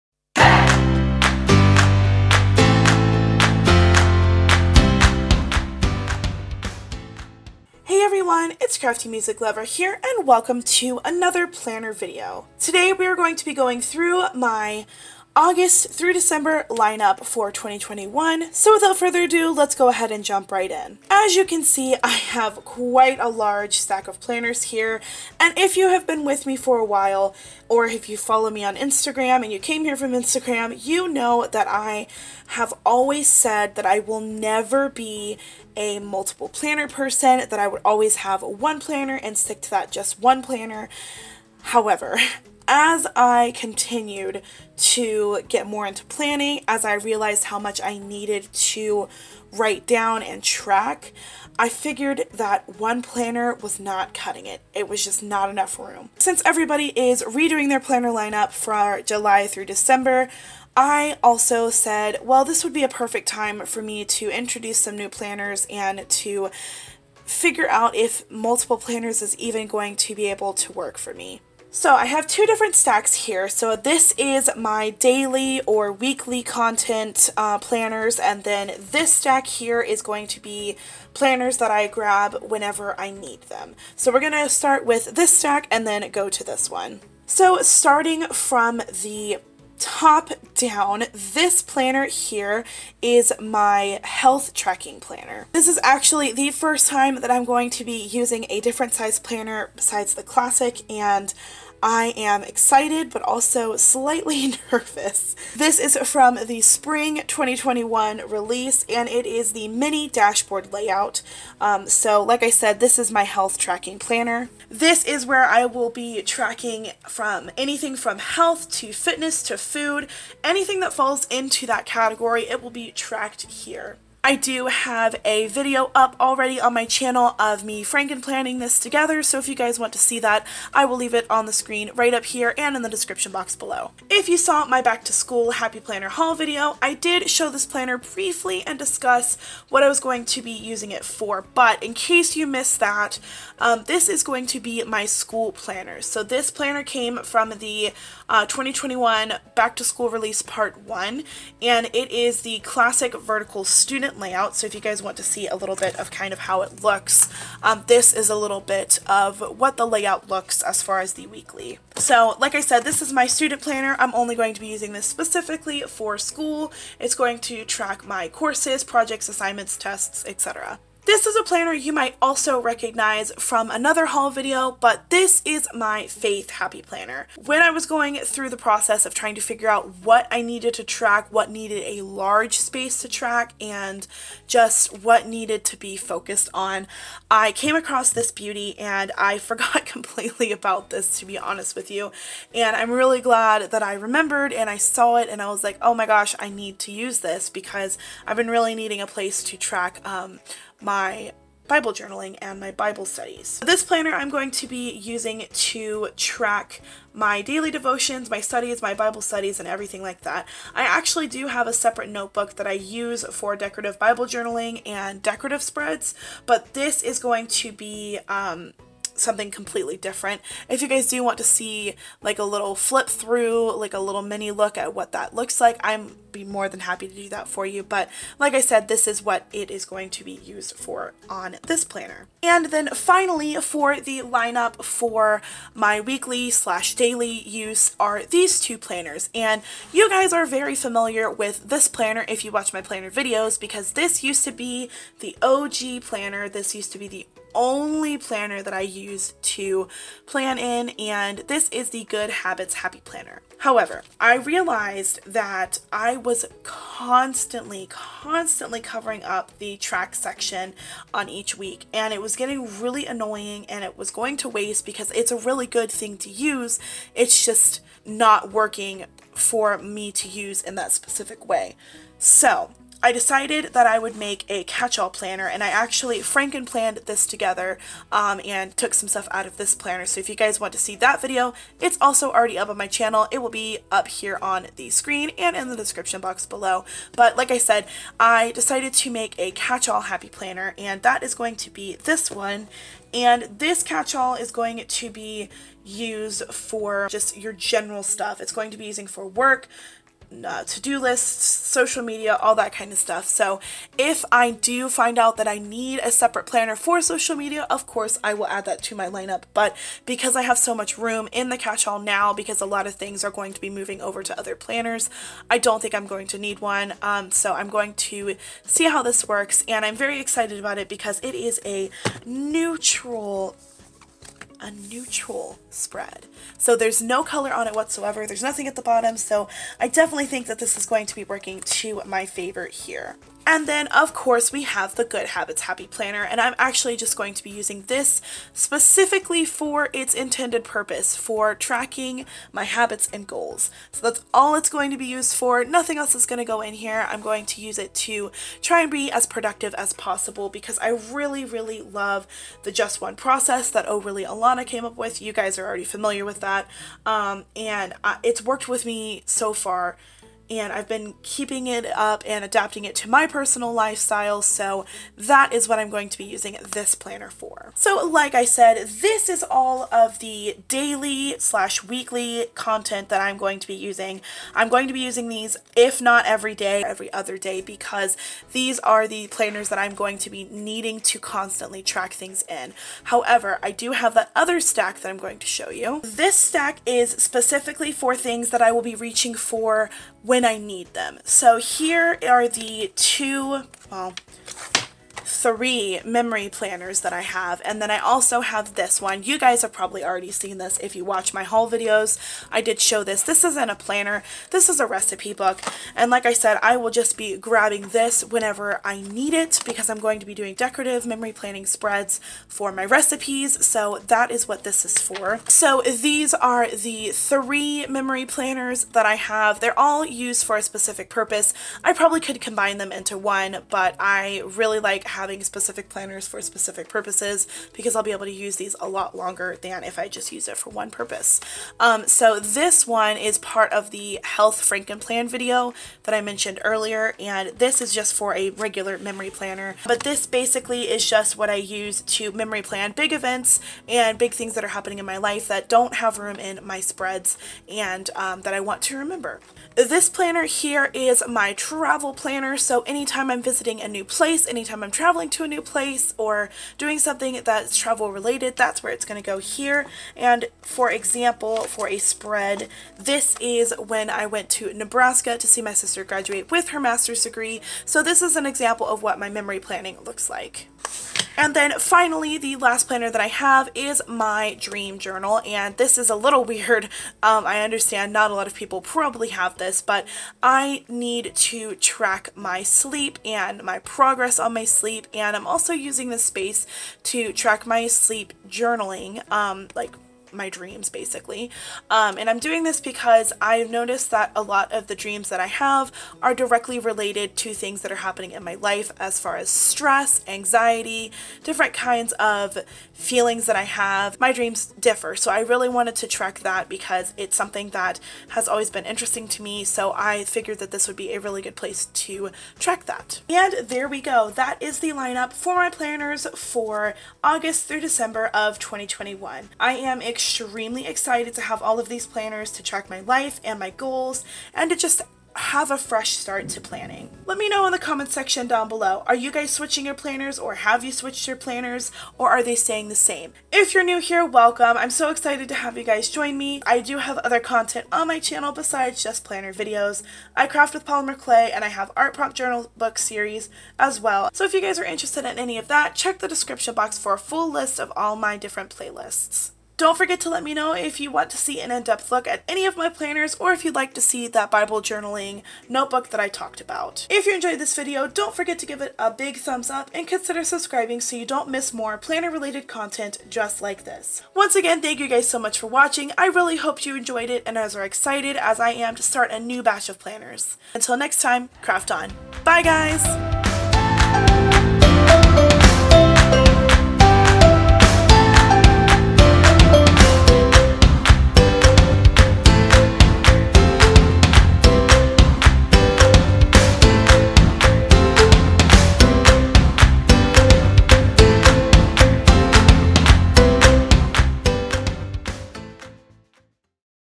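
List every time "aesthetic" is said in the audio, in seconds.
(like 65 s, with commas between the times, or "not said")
not said.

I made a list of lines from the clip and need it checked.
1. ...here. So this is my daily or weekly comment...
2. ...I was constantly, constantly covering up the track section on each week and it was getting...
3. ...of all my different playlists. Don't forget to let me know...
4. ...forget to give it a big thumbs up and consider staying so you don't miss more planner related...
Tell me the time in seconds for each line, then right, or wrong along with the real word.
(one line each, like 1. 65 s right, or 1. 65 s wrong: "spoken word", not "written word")
1. 73 s wrong: "content", not "comment"
2. 255 s right
3. 547 s right
4. 558 s wrong: "subscribing", not "staying".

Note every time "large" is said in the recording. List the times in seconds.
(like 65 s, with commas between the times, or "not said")
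23 s, 182 s.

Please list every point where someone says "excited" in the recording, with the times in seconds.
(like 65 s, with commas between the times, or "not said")
102 s, 320 s, 520 s, 535 s, 567 s.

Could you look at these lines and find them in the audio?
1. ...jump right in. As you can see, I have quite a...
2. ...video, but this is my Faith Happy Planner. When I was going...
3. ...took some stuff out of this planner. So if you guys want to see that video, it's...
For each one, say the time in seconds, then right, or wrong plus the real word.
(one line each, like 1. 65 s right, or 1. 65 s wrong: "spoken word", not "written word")
1. 20 s right
2. 174 s right
3. 278 s right.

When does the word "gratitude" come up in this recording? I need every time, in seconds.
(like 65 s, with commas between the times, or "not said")
not said.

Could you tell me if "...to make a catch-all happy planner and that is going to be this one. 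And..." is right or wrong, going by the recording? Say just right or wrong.
right.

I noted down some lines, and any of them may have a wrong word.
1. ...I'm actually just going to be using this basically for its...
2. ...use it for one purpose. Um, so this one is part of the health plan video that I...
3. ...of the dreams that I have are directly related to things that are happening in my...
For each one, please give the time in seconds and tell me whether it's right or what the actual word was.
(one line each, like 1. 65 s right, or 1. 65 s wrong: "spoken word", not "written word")
1. 336 s wrong: "specifically", not "basically"
2. 430 s right
3. 494 s right.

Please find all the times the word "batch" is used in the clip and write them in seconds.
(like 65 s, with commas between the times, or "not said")
569 s.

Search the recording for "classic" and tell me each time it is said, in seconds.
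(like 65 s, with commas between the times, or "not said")
100 s, 152 s.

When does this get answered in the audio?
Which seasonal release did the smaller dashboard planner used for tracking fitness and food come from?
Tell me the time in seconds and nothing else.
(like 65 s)
106 s.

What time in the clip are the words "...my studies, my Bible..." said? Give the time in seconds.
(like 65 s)
208 s.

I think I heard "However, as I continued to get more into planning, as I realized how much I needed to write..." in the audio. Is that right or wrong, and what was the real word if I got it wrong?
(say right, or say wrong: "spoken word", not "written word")
right.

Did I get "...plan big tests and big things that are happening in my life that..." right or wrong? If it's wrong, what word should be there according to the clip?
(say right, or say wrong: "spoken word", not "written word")
wrong: "events", not "tests".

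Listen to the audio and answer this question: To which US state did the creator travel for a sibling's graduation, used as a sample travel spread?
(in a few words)
Nebraska.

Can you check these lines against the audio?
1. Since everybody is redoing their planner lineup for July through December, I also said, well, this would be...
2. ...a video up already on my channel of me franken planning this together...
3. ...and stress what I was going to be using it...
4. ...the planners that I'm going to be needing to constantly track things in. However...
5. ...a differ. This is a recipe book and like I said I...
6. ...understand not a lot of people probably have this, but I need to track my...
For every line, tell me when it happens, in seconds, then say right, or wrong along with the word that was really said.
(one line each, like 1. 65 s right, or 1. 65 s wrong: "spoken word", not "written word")
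1. 56 s right
2. 125 s right
3. 138 s wrong: "discuss", not "stress"
4. 379 s right
5. 403 s wrong: "planner", not "differ"
6. 477 s right.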